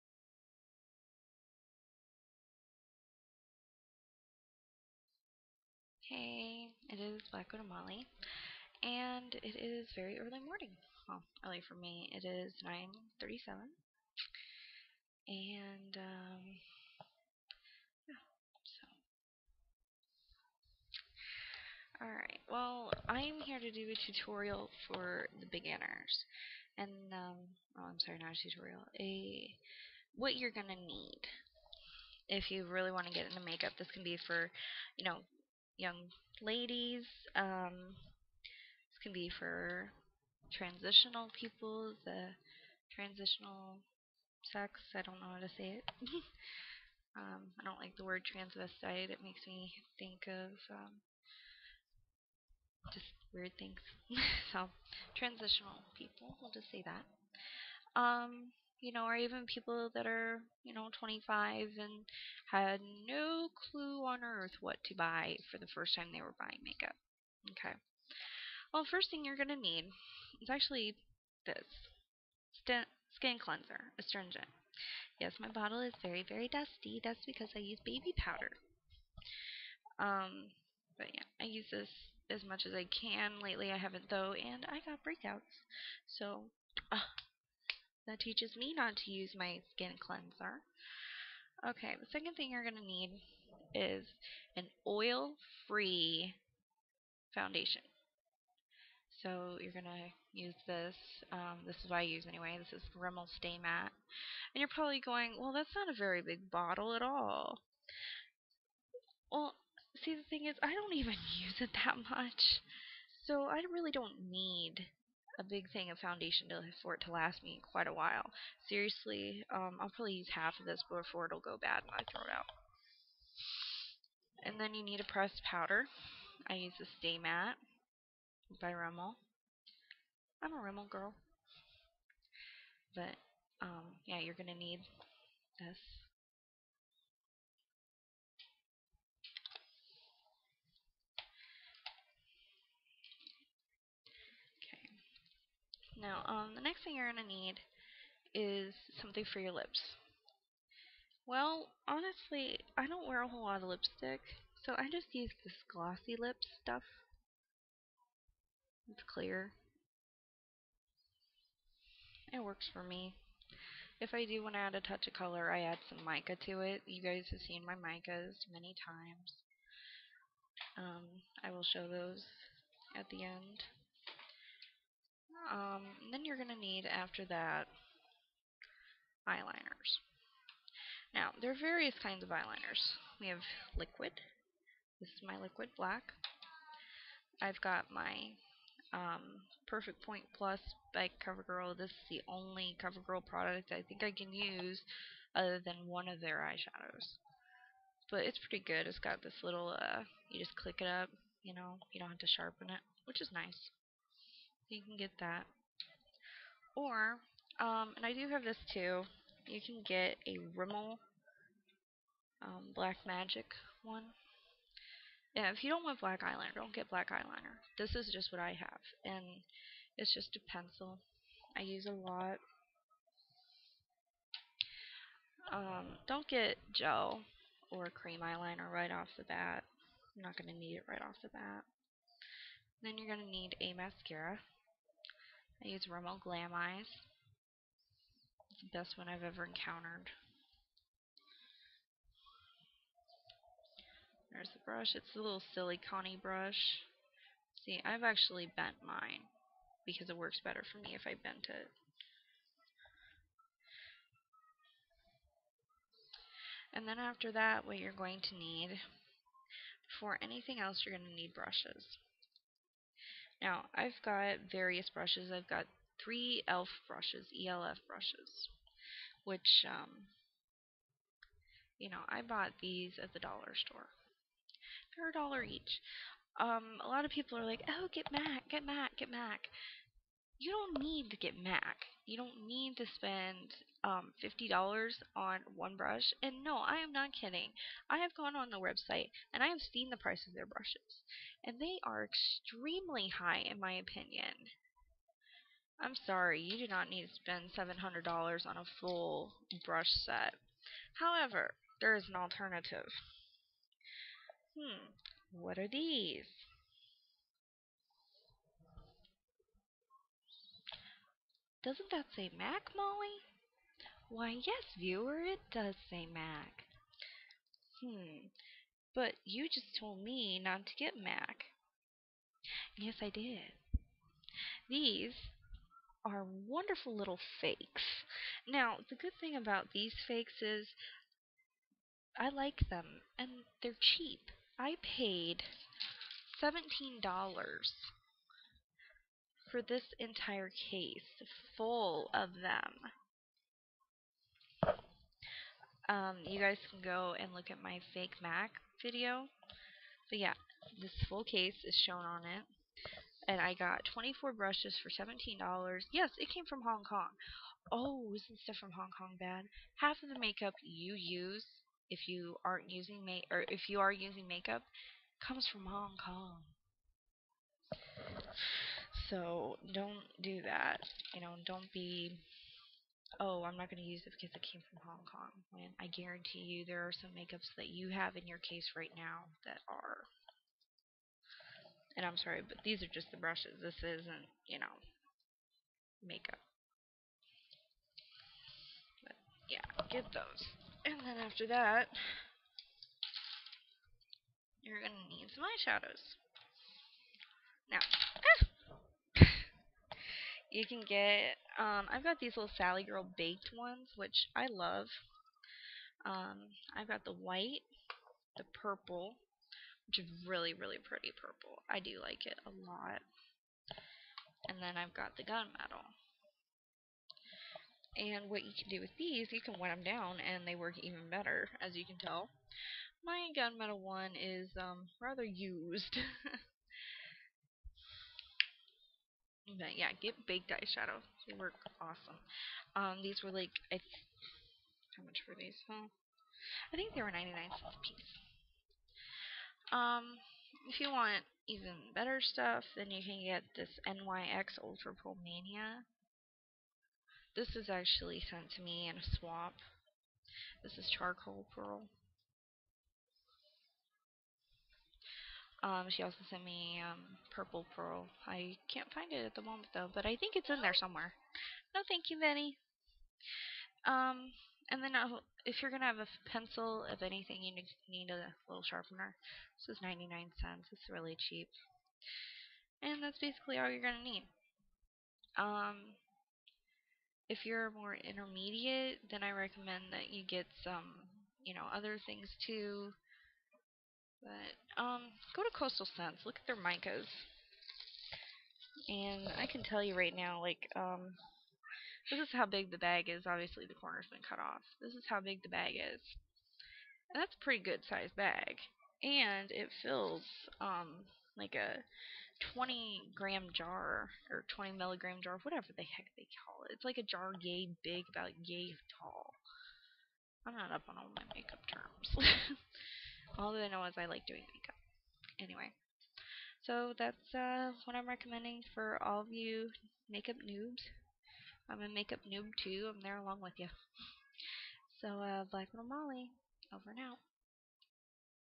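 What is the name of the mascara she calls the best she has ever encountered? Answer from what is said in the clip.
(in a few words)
Rimmel Glam Eyes.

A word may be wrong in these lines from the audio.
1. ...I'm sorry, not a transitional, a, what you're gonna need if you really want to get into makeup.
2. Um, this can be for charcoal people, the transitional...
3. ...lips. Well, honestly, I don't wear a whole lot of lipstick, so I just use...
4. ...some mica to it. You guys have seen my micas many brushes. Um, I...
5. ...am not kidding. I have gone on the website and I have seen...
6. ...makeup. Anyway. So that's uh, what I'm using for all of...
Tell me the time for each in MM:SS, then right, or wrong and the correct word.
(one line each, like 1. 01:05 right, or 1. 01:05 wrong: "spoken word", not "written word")
1. 00:27 wrong: "tutorial", not "transitional"
2. 00:37 wrong: "transitional", not "charcoal"
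3. 02:29 right
4. 02:45 wrong: "times", not "brushes"
5. 04:46 right
6. 08:34 wrong: "recommending", not "using".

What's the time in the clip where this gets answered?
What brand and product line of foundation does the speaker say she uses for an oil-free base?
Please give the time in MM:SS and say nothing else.
01:42.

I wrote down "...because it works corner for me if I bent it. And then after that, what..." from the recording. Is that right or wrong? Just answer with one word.
wrong.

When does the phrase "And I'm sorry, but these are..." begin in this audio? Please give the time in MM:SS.
06:21.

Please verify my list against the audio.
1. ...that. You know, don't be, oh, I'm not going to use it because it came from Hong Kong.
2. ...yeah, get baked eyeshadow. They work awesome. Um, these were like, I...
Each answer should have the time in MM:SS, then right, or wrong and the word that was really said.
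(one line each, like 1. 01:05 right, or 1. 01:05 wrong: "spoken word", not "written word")
1. 06:10 right
2. 07:09 right.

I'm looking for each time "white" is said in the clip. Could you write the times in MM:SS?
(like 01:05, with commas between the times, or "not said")
06:47.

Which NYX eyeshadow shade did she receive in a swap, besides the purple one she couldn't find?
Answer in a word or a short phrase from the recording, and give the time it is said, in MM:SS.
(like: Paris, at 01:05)
charcoal pearl, at 07:30.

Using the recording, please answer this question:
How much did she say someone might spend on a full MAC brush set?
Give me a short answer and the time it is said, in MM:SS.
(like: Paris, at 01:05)
$700, at 04:57.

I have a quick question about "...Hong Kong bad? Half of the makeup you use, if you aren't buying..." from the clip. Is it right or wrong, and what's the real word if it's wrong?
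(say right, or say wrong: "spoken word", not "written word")
wrong: "using", not "buying".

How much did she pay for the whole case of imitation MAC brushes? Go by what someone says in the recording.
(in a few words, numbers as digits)
$17.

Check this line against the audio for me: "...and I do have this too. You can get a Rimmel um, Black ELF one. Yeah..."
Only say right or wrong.
wrong.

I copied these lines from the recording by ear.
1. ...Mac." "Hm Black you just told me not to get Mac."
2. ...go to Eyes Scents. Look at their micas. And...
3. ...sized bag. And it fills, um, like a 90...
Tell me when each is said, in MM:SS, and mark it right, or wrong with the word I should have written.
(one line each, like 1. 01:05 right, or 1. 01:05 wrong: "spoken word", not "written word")
1. 05:16 wrong: "But", not "Black"
2. 08:05 wrong: "Coastal", not "Eyes"
3. 08:17 wrong: "20", not "90".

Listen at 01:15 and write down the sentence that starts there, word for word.
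Yes, my bottle is very, very dusty.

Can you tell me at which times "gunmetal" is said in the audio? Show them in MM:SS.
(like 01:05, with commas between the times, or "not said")
06:55, 07:03.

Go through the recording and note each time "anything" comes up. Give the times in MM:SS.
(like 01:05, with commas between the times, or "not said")
04:20, 07:47.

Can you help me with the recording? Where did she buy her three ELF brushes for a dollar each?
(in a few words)
the dollar store.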